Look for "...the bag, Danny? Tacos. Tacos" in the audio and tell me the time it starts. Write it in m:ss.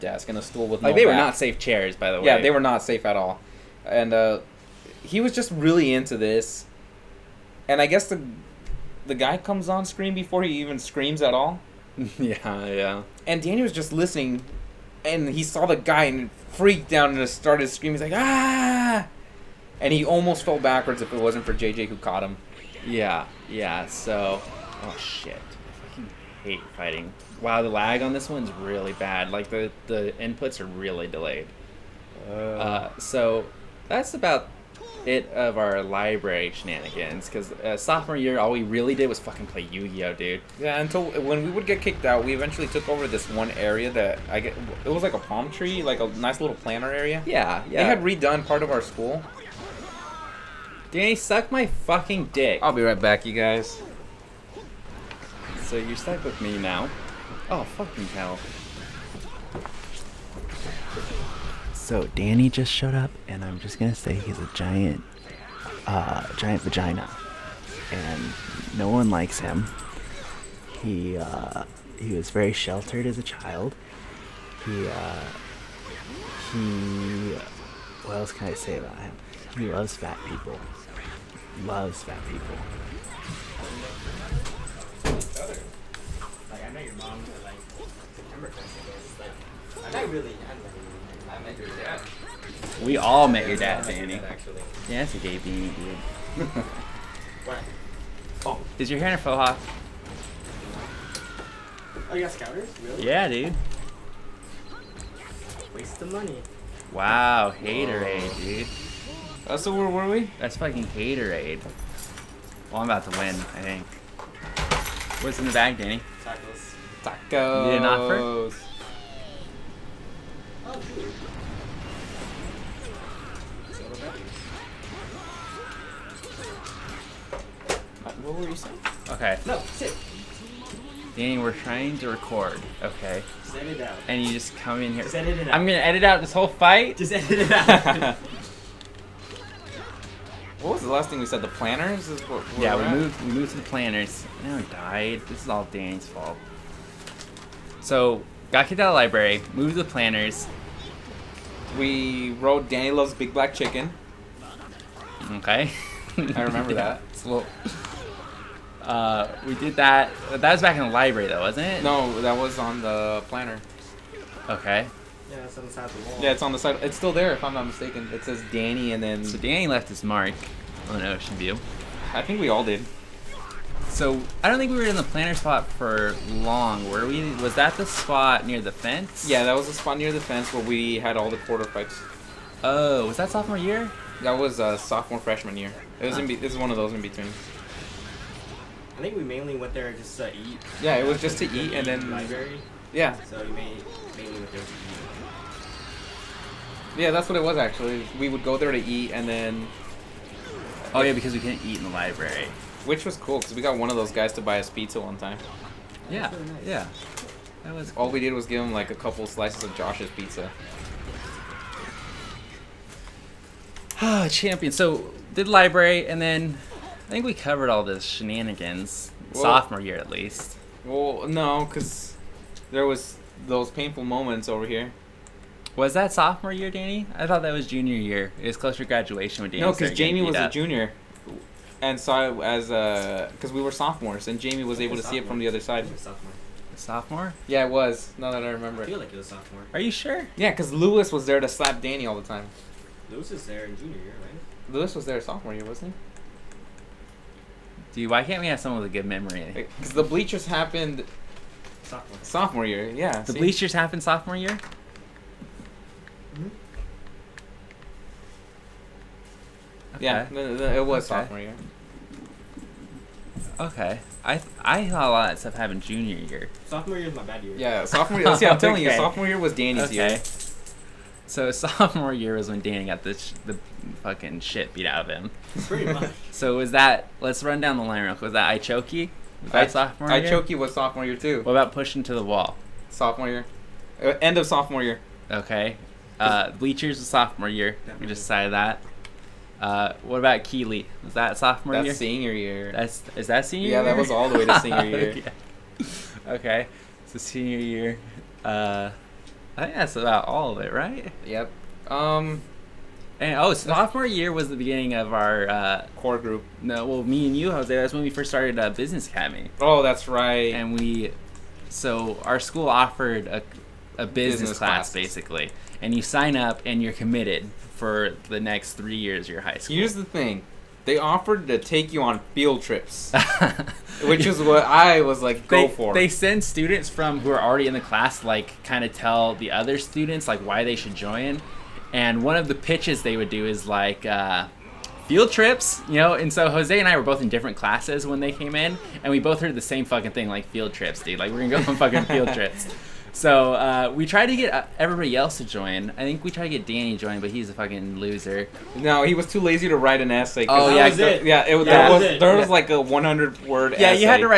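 1:55.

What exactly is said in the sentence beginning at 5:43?
So uh, we tried to get uh, everybody else to join.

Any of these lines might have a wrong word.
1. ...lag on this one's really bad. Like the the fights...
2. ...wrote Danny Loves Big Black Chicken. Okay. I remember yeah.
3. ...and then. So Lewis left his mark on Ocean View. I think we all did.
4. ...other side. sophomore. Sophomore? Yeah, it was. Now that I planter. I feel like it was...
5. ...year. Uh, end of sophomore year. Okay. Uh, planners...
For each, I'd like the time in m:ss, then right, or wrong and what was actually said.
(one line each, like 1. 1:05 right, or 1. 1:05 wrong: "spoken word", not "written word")
1. 0:27 wrong: "inputs", not "fights"
2. 2:32 right
3. 2:48 wrong: "Danny", not "Lewis"
4. 3:55 wrong: "remember", not "planter"
5. 4:43 wrong: "bleachers", not "planners".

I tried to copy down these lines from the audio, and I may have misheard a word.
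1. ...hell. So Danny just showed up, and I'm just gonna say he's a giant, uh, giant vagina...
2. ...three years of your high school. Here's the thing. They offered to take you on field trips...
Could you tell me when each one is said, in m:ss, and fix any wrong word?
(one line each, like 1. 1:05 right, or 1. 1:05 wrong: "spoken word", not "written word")
1. 0:58 right
2. 5:18 right.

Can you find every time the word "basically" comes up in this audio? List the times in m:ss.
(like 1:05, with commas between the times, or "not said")
5:14.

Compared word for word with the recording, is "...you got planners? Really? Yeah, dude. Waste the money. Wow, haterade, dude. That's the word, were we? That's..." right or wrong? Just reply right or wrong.
wrong.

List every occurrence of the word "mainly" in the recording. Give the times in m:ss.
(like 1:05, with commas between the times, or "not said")
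3:09, 3:13.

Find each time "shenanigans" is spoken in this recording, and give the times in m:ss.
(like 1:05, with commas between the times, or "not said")
0:36, 3:38.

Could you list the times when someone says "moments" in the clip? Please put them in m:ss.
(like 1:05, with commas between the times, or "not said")
3:44.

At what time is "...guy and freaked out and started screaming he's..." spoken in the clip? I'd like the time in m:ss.
0:15.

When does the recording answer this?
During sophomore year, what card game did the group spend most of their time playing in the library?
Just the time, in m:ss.
0:39.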